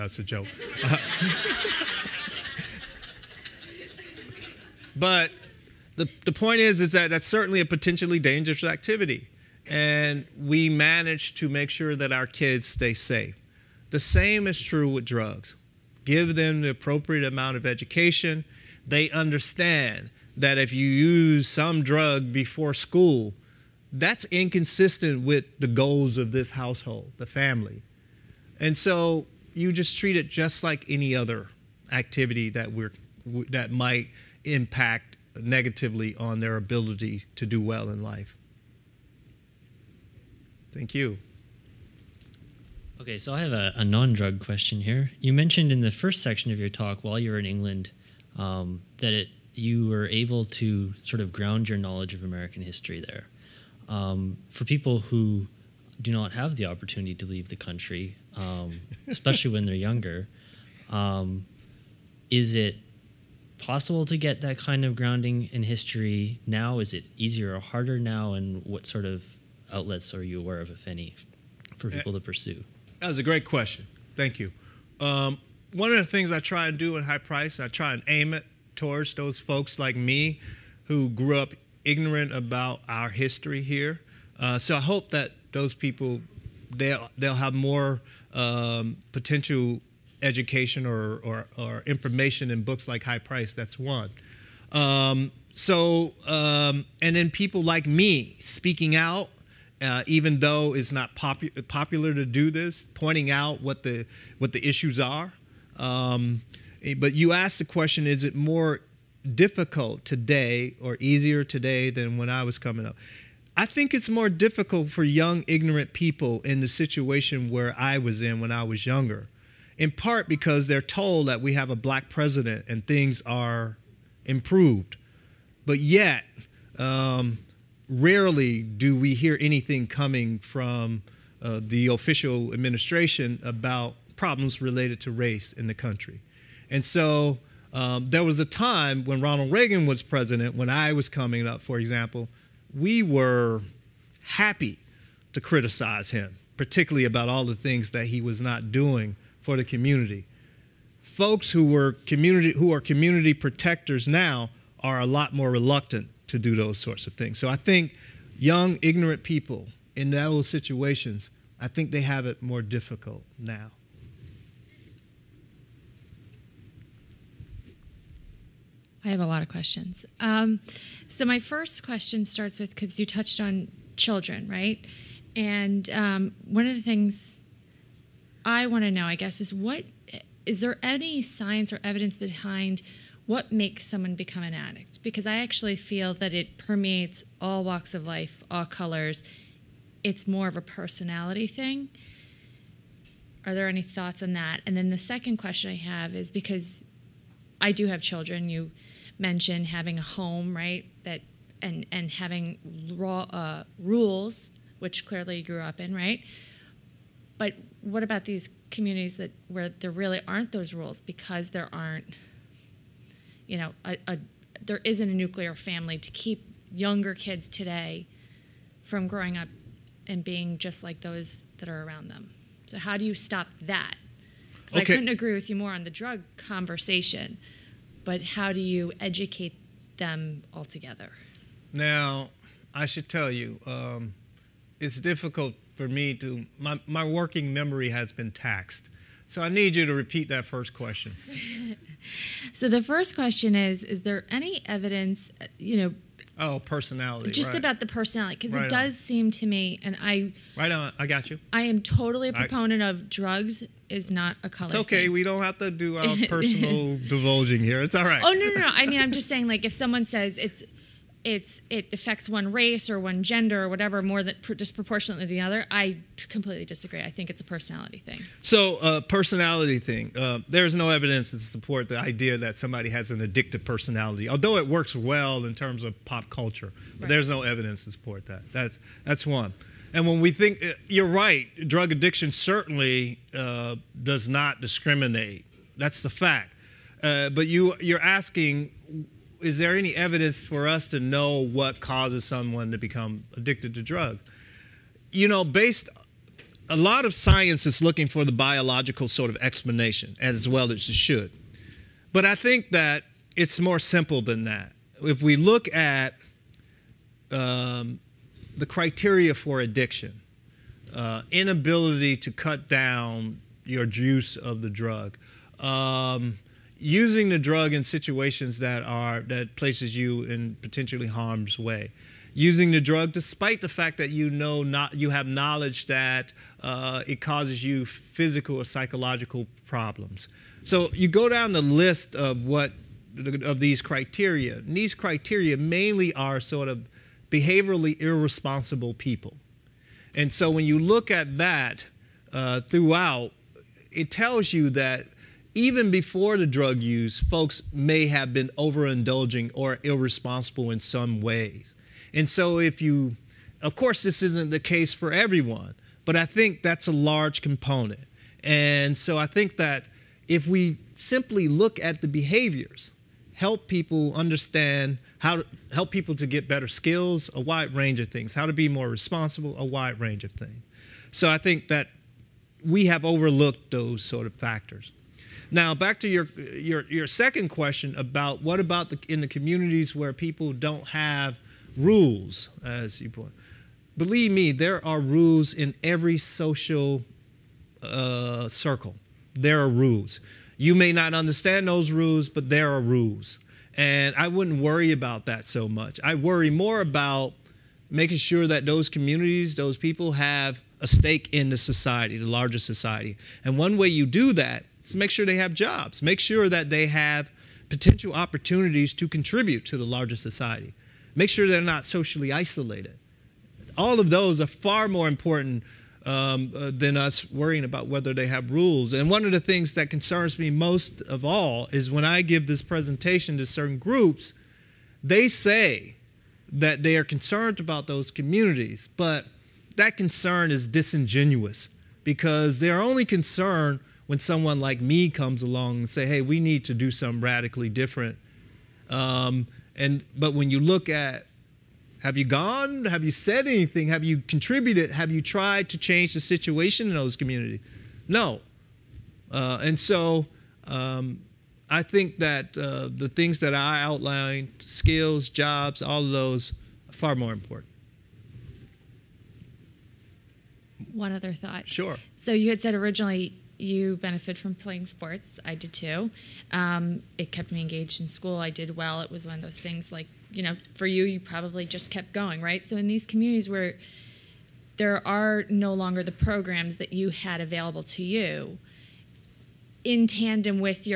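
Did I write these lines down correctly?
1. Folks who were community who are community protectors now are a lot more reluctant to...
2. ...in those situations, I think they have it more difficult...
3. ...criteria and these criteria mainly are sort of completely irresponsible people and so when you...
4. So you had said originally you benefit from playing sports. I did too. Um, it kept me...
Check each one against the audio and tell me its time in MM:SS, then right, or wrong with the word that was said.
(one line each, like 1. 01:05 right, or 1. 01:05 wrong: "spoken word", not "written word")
1. 02:31 right
2. 02:39 right
3. 05:33 wrong: "behaviorally", not "completely"
4. 07:42 right.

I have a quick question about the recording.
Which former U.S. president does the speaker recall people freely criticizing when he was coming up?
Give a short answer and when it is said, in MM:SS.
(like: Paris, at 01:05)
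Ronald Reagan, at 02:19.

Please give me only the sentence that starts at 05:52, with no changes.
And so, if you, of course, this isn't the case for everyone, but I think that's a large component.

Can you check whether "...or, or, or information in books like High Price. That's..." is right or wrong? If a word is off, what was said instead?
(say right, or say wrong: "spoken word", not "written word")
right.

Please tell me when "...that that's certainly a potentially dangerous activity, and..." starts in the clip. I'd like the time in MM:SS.
00:06.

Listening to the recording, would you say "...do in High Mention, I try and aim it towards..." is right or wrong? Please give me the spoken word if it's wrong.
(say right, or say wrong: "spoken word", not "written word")
wrong: "Price", not "Mention".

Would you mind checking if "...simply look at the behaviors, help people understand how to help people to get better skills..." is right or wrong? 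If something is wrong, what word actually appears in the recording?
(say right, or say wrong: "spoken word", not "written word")
right.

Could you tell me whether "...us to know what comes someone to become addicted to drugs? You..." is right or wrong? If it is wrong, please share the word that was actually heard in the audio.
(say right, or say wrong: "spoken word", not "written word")
wrong: "causes", not "comes".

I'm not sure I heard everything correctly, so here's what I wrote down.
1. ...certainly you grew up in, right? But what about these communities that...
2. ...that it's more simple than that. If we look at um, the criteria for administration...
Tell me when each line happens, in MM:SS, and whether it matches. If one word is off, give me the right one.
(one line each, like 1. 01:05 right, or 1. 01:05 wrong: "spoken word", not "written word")
1. 03:25 wrong: "clearly", not "certainly"
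2. 05:02 wrong: "addiction", not "administration".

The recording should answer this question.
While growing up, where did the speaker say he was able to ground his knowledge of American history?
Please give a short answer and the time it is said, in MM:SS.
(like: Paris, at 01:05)
England, at 00:47.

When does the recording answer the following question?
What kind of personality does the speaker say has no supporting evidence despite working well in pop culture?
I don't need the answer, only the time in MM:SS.
04:33.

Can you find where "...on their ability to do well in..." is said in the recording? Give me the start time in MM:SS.
00:36.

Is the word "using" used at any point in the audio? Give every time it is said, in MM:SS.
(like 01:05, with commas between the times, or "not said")
05:16, 05:22.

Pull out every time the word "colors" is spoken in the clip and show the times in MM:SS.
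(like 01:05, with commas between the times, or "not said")
03:08, 04:14.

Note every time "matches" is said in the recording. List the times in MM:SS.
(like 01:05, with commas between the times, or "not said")
not said.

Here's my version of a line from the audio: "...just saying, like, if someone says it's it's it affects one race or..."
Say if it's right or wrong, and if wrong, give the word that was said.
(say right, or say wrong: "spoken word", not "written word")
right.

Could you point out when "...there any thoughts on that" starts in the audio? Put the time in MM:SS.
03:13.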